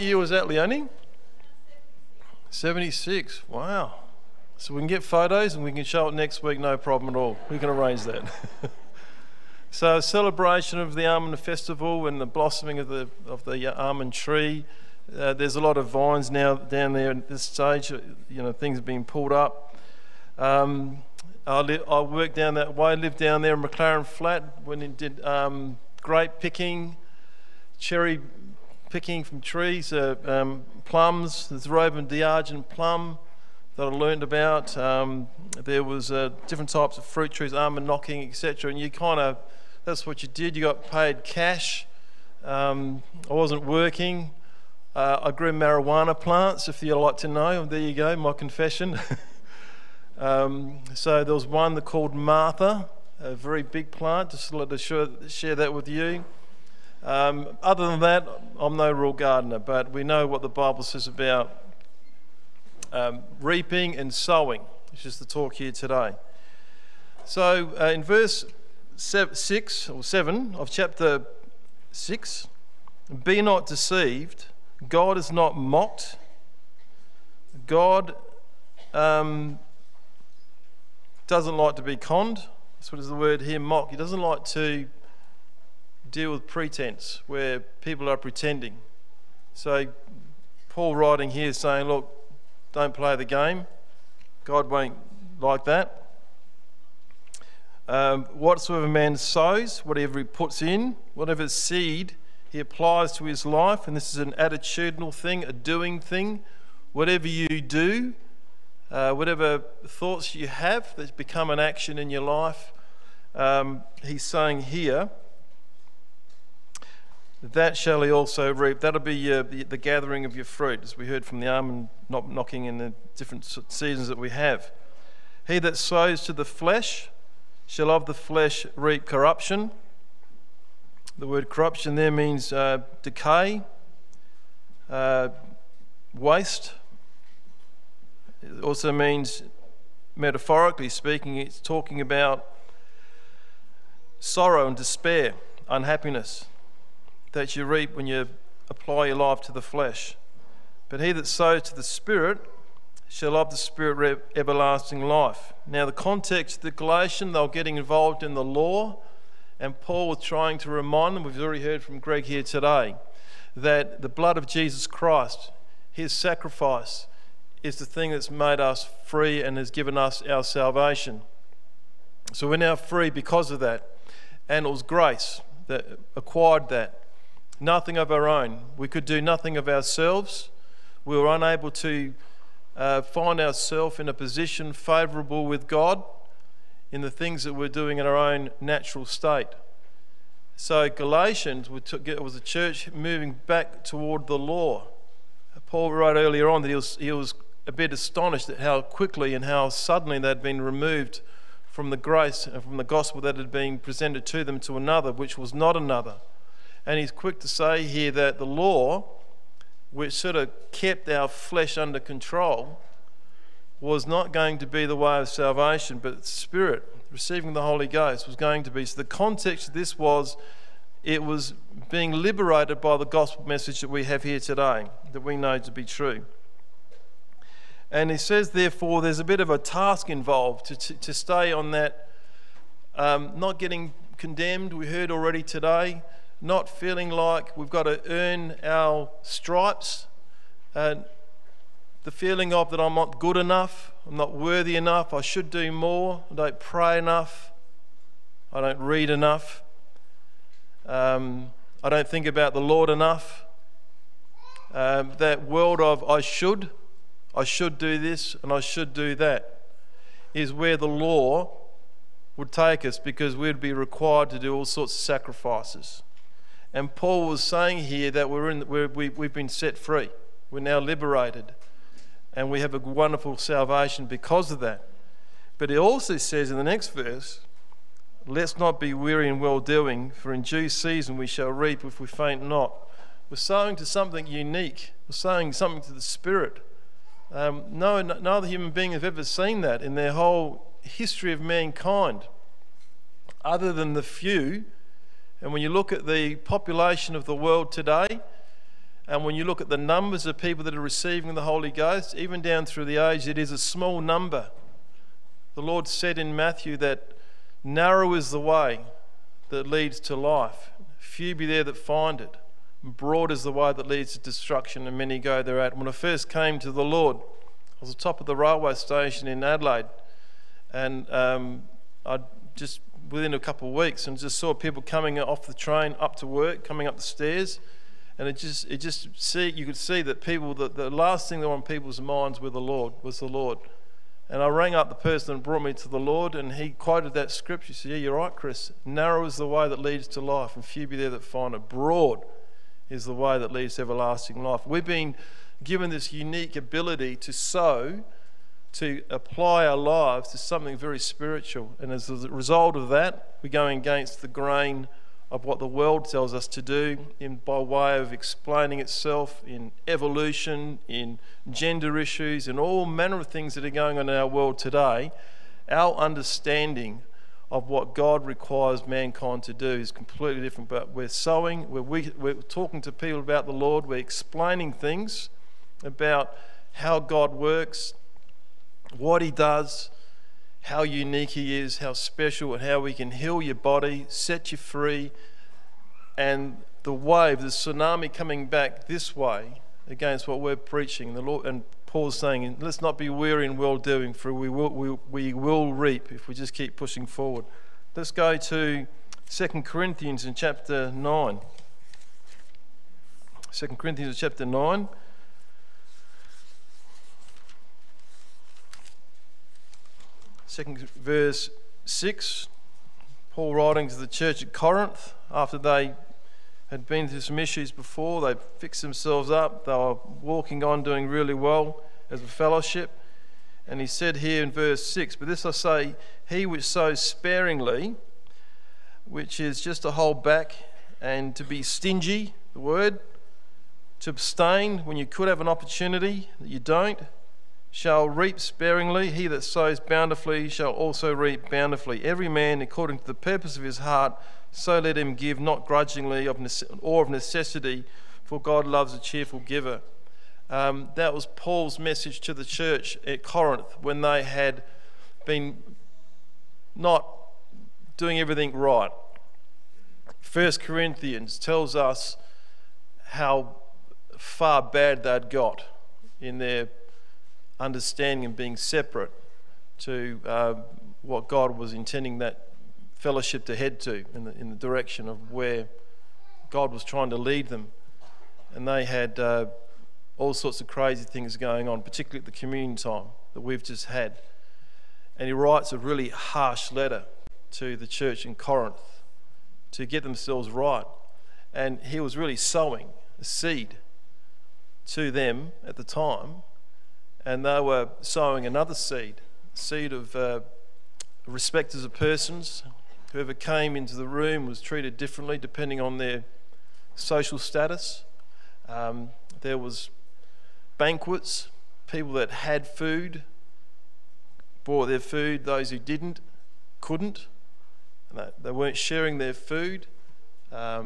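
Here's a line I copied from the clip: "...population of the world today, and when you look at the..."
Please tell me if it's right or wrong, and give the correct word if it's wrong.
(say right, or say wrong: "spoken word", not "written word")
right.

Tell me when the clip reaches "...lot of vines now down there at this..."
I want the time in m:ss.
0:15.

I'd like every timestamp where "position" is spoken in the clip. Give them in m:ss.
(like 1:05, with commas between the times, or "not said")
3:04.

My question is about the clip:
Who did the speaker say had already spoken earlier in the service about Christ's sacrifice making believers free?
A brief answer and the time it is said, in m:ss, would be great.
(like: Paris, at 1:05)
Greg, at 2:41.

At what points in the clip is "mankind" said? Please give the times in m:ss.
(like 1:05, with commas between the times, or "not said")
4:51, 6:08.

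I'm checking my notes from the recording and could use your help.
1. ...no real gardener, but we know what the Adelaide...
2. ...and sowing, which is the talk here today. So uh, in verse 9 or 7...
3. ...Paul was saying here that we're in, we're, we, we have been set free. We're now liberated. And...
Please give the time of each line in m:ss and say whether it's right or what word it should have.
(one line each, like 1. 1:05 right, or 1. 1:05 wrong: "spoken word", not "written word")
1. 0:58 wrong: "Bible", not "Adelaide"
2. 1:03 wrong: "6", not "9"
3. 4:26 right.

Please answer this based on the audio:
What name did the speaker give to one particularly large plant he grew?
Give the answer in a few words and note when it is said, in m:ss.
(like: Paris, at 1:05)
Martha, at 0:52.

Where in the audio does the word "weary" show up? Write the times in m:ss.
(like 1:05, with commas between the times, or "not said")
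4:38, 6:33.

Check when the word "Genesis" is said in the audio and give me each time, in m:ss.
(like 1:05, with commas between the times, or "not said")
not said.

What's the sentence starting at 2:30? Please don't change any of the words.
But he that sows to the Spirit shall of the Spirit everlasting life.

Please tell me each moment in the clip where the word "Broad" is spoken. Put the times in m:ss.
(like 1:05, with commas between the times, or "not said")
5:12, 5:41.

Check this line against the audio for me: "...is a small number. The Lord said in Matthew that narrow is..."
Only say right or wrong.
right.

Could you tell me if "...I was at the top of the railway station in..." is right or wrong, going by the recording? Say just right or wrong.
right.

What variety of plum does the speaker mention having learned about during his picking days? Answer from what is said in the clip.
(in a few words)
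Robe de Sergeant.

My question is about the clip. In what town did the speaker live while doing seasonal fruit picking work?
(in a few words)
McLaren Flat.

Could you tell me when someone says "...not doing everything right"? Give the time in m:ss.
7:36.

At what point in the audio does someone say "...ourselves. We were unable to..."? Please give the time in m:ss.
2:59.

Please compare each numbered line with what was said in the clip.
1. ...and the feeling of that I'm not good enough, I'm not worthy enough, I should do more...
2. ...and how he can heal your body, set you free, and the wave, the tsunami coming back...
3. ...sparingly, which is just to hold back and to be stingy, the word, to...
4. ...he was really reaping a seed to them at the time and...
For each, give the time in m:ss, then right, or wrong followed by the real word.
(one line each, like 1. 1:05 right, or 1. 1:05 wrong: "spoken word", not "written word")
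1. 4:00 right
2. 6:22 right
3. 7:07 right
4. 8:11 wrong: "sowing", not "reaping".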